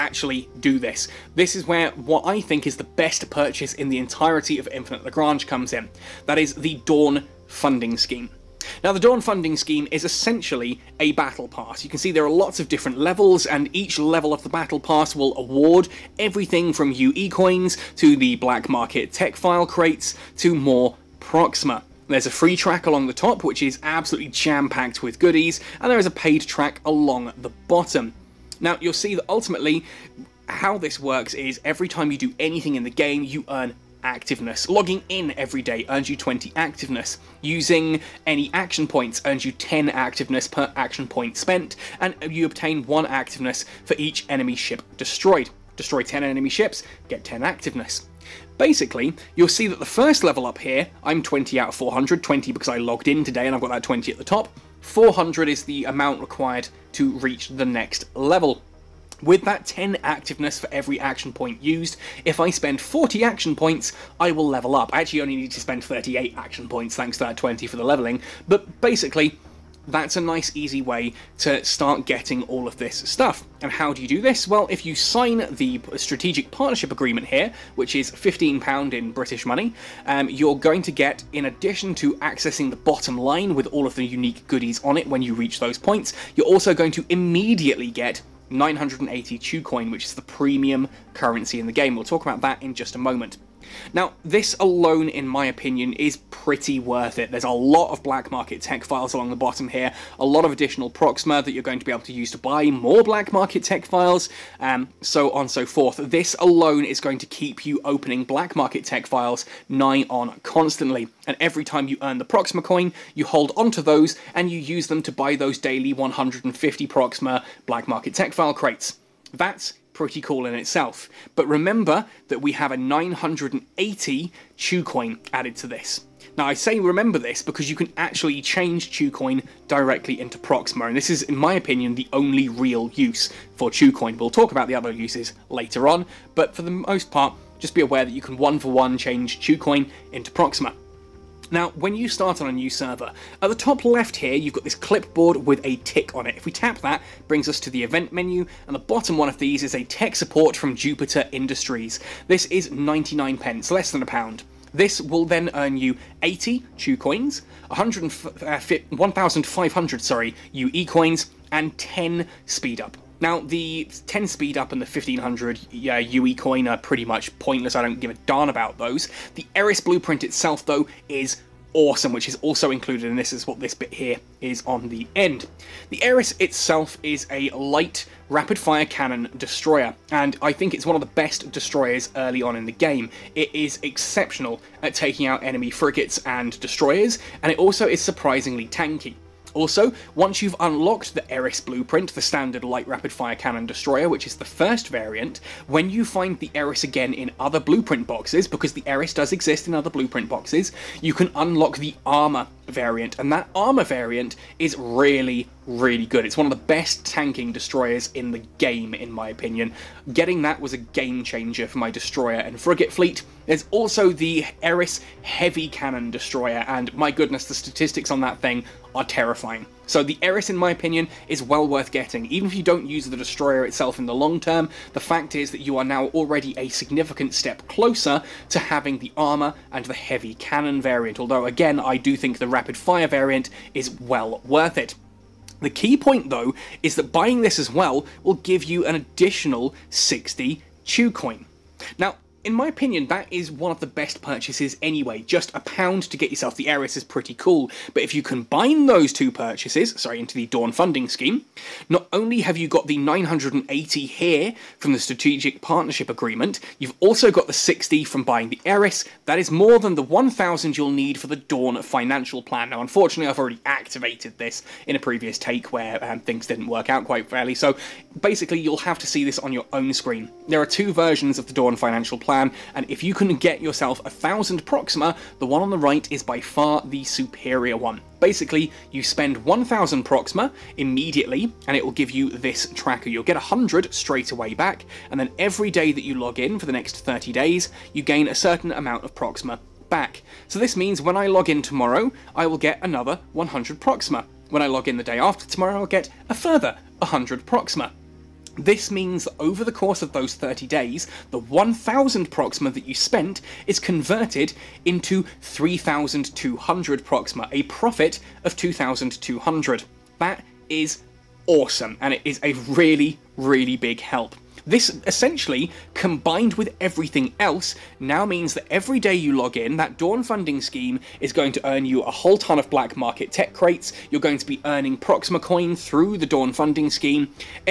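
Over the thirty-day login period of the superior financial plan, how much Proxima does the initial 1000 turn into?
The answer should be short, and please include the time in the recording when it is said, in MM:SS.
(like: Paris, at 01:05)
3200, at 05:05.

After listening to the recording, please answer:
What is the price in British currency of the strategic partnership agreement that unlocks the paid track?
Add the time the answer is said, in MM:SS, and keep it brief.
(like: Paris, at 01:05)
£15, at 01:18.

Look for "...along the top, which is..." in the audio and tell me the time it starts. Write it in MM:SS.
00:22.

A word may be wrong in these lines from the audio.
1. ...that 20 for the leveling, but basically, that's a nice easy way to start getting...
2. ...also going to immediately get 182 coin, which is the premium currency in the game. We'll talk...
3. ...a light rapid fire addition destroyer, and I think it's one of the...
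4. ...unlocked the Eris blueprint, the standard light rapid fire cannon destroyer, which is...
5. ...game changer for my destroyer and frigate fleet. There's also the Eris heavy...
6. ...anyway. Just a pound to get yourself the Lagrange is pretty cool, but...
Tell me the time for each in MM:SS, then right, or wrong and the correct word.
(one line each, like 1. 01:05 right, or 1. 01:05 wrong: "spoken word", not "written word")
1. 01:07 right
2. 01:26 wrong: "982", not "182"
3. 02:57 wrong: "cannon", not "addition"
4. 03:10 right
5. 03:30 right
6. 04:04 wrong: "Eris", not "Lagrange".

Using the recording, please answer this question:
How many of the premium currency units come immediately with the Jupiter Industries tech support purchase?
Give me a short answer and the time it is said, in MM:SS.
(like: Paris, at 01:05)
80, at 02:36.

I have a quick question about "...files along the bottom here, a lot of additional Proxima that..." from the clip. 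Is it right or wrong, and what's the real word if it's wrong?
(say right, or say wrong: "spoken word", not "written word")
right.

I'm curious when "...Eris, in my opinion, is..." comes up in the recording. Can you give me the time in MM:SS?
03:40.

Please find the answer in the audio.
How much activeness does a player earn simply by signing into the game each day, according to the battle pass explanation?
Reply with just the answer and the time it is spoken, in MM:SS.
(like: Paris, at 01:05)
20, at 00:36.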